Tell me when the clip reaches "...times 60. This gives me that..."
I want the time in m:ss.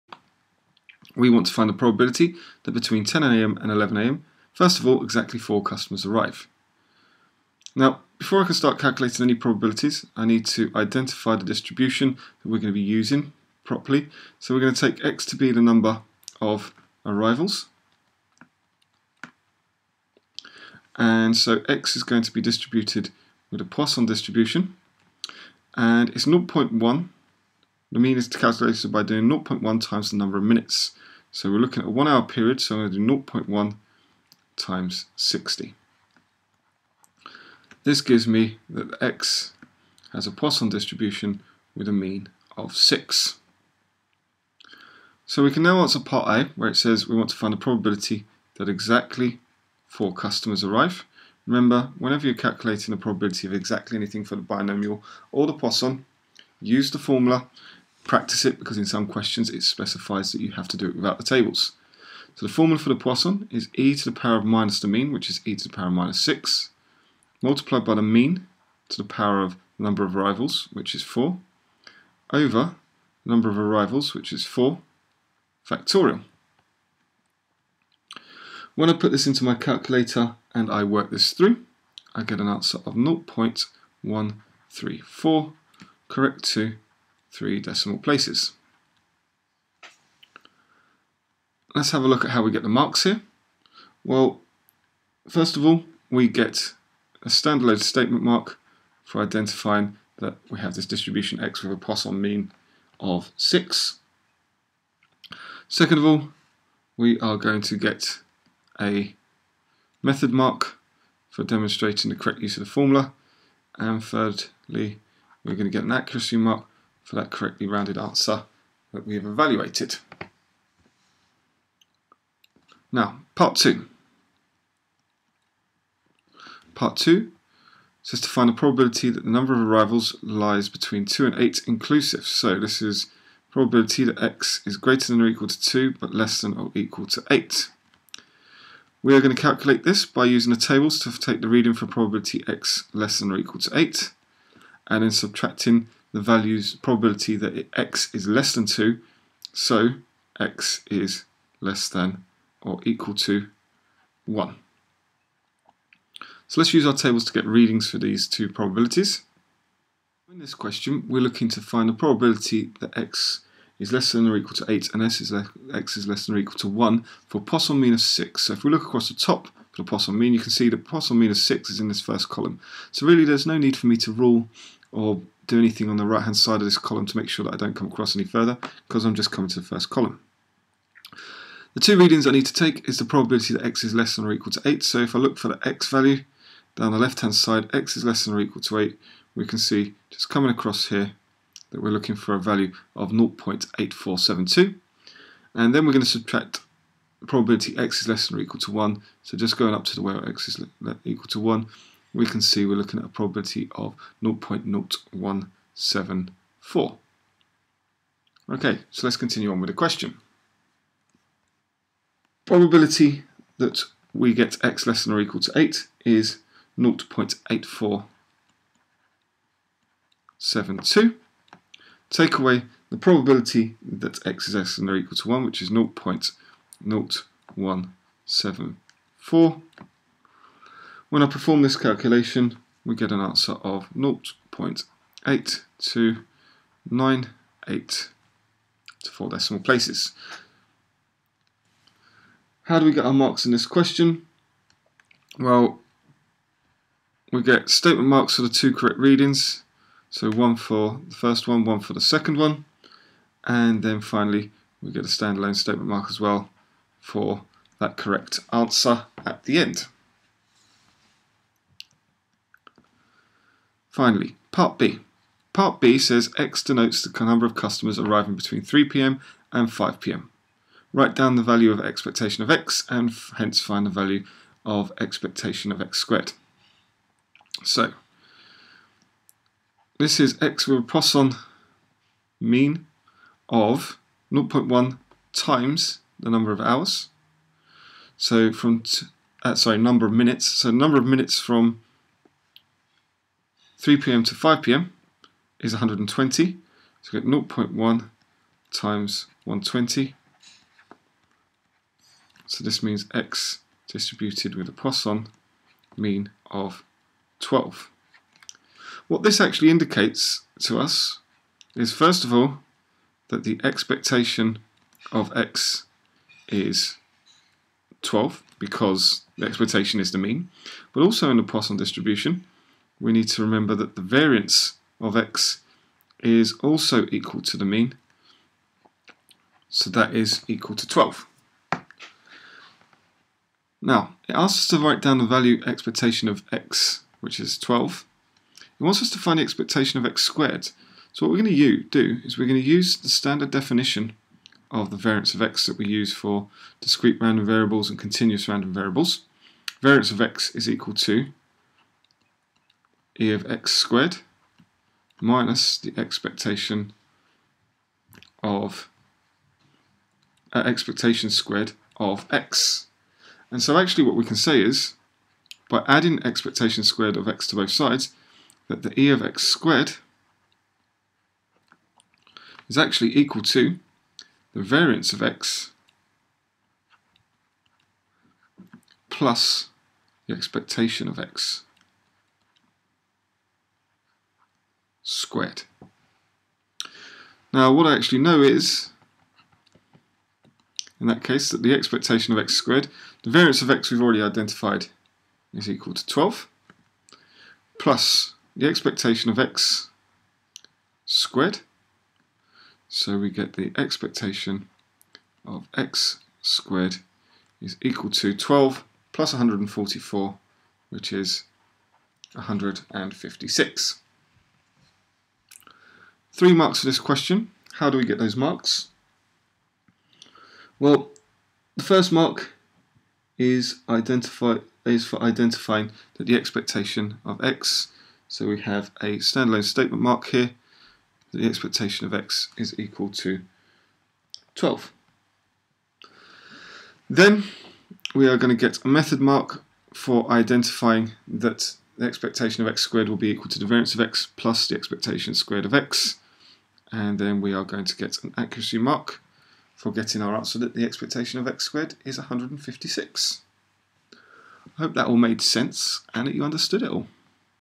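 0:34.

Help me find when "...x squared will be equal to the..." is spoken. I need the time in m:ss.
7:22.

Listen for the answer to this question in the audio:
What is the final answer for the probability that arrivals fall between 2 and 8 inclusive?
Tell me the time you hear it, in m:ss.
3:53.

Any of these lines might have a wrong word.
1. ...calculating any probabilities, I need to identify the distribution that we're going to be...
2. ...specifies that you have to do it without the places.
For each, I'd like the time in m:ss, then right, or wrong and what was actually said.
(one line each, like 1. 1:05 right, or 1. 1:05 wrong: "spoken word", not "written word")
1. 0:08 right
2. 0:59 wrong: "tables", not "places".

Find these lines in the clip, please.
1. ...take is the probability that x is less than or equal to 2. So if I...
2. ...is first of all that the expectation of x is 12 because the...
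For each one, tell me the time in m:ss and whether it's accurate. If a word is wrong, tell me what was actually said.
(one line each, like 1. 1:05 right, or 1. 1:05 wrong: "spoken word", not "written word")
1. 3:02 wrong: "8", not "2"
2. 5:11 right.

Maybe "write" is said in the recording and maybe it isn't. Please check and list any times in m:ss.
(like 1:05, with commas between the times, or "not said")
4:30, 5:34.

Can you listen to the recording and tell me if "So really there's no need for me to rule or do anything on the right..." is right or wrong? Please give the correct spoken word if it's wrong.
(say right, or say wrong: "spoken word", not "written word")
right.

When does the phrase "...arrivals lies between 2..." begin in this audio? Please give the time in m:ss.
2:09.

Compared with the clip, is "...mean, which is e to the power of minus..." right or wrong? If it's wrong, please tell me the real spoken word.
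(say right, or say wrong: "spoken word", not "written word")
right.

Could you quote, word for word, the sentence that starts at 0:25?
And it's 0.1 the mean is calculated by doing 0.1 times the number of minutes.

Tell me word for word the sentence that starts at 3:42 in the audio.
Take away the probability that x is less than or equal to 1, which is 0.0174.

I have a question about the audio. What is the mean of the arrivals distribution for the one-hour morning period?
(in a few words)
6.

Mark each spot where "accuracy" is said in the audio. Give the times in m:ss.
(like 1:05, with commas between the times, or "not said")
1:55, 7:28.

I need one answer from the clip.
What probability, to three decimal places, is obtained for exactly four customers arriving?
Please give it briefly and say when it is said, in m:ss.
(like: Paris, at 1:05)
0.134, at 1:22.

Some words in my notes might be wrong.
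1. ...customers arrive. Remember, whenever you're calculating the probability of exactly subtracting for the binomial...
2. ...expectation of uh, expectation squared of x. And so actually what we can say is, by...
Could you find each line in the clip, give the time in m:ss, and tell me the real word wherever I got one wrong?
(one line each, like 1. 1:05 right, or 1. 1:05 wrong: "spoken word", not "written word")
1. 0:50 wrong: "anything", not "subtracting"
2. 5:55 right.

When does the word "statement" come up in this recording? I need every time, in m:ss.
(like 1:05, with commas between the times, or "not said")
1:37, 4:07, 4:15, 7:09.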